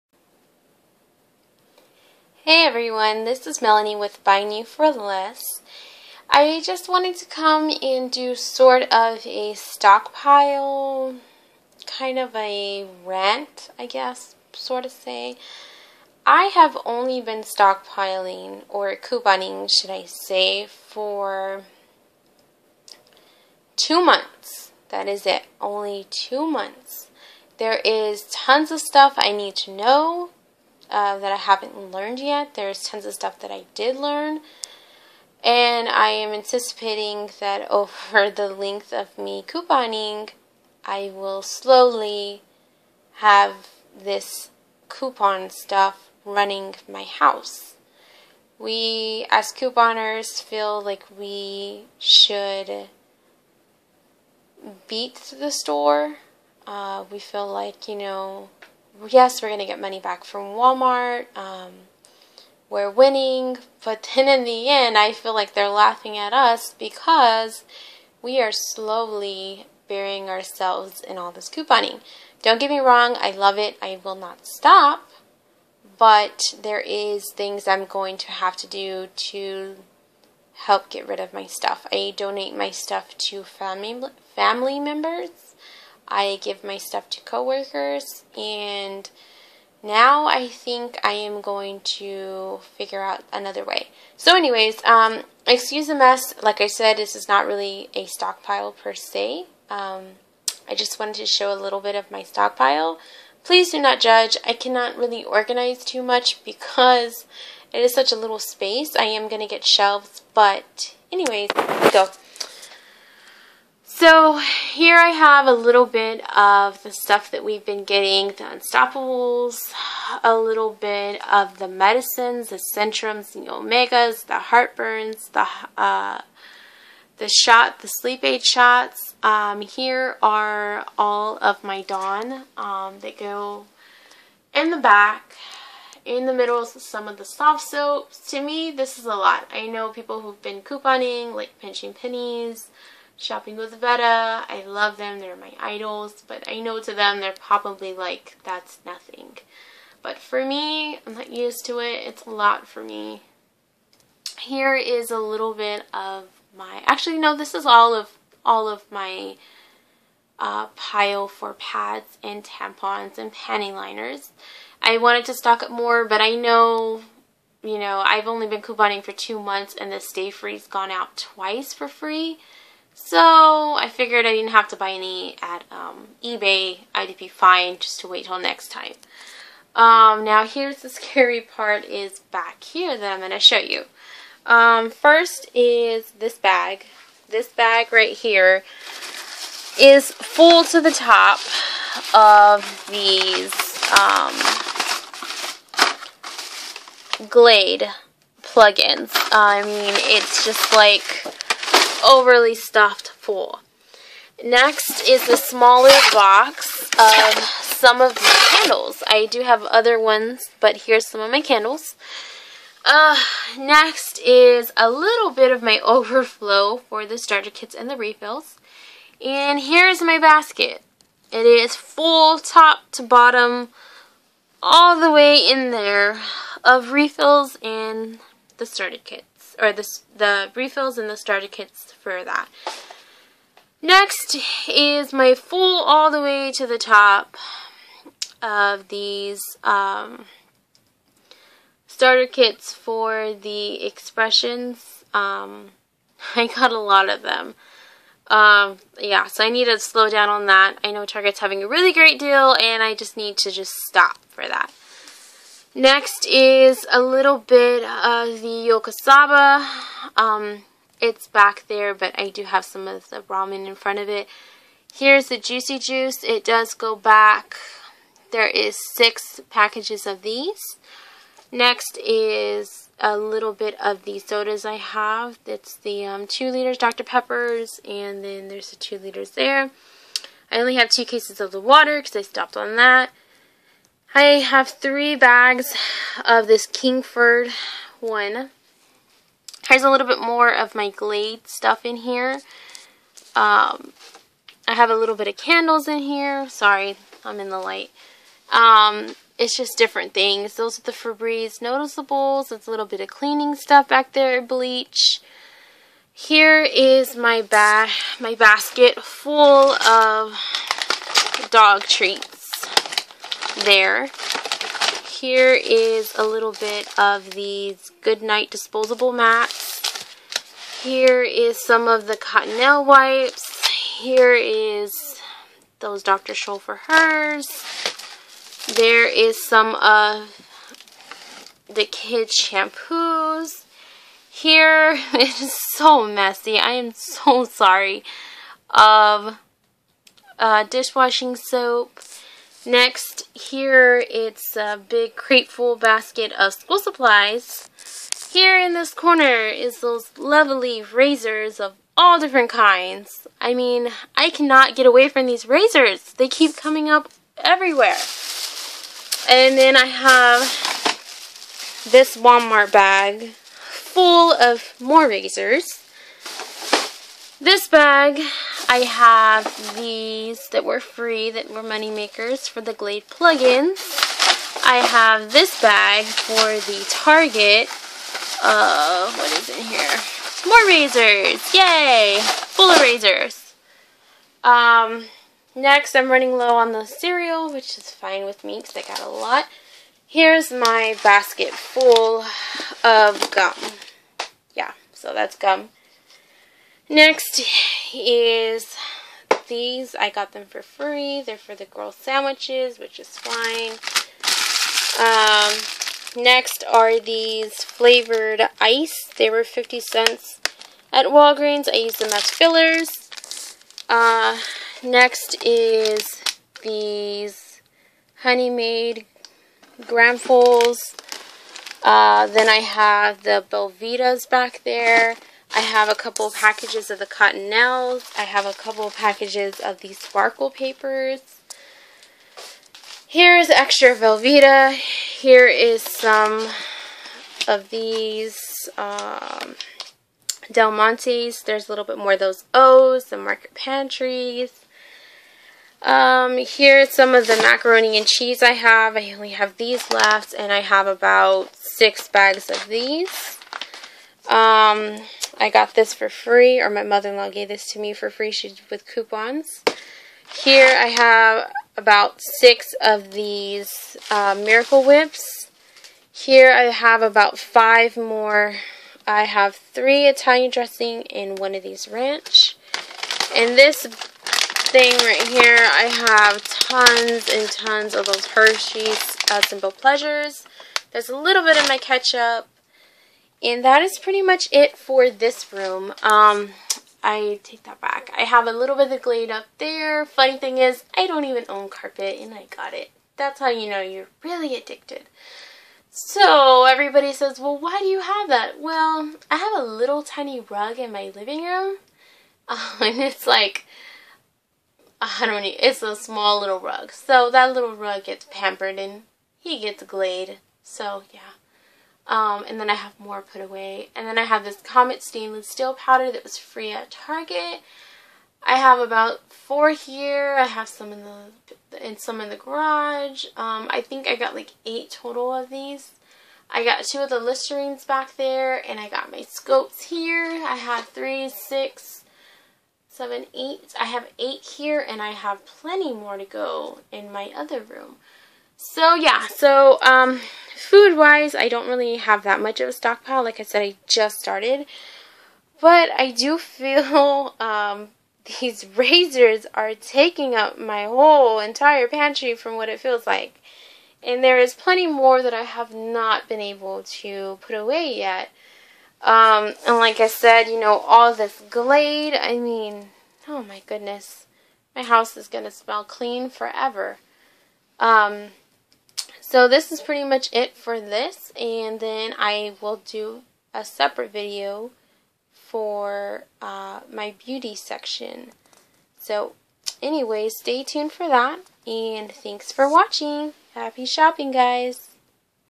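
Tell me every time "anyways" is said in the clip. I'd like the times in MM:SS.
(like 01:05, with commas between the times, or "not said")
01:34, 01:51, 09:39.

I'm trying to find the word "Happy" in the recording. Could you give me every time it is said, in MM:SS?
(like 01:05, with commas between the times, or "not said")
09:43.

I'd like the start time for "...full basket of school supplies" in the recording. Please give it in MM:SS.
05:45.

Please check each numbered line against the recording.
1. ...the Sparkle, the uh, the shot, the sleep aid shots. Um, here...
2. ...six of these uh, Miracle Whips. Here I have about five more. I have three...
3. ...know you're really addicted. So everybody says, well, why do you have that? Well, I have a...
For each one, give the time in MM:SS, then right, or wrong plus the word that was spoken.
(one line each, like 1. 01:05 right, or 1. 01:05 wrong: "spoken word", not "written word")
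1. 02:04 wrong: "Heartburns", not "Sparkle"
2. 07:42 right
3. 08:13 right.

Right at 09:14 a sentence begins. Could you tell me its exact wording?
And there is plenty more that I have not been able to put away yet.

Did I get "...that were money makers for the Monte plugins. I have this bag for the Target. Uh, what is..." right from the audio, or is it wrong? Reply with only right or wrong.
wrong.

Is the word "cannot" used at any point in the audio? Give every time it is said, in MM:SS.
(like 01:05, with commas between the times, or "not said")
01:44, 05:54.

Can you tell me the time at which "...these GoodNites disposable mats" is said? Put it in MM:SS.
05:17.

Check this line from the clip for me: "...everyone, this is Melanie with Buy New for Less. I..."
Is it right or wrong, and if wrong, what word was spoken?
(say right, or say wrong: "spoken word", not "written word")
right.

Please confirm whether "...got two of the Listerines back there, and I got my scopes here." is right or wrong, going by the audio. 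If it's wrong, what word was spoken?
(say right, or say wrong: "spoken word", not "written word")
right.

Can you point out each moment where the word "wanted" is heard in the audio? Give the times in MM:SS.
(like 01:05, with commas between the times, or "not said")
00:06, 01:40, 02:44.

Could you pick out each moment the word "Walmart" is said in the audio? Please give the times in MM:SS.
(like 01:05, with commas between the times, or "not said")
01:00, 06:02.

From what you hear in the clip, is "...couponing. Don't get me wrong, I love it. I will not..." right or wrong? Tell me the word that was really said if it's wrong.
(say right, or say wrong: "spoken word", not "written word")
right.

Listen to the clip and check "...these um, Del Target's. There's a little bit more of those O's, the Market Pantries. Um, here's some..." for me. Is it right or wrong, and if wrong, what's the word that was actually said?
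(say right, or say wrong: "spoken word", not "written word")
wrong: "Monte", not "Target".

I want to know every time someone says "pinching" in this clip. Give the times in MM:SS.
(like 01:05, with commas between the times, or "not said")
02:21.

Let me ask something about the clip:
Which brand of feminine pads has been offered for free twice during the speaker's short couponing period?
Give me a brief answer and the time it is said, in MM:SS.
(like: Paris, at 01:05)
Stayfree, at 02:49.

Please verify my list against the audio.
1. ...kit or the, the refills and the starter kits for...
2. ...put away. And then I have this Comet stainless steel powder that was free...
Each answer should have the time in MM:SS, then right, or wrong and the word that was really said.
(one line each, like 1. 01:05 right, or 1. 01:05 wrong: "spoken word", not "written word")
1. 03:49 right
2. 08:33 right.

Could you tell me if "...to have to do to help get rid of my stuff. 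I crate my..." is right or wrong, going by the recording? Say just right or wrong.
wrong.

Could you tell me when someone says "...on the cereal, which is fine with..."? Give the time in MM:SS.
06:26.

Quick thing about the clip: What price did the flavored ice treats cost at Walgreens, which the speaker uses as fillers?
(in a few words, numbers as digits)
50 cents.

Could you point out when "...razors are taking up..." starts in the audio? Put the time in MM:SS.
09:08.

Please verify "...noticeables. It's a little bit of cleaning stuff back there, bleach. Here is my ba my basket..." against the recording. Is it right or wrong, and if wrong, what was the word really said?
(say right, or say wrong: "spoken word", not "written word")
right.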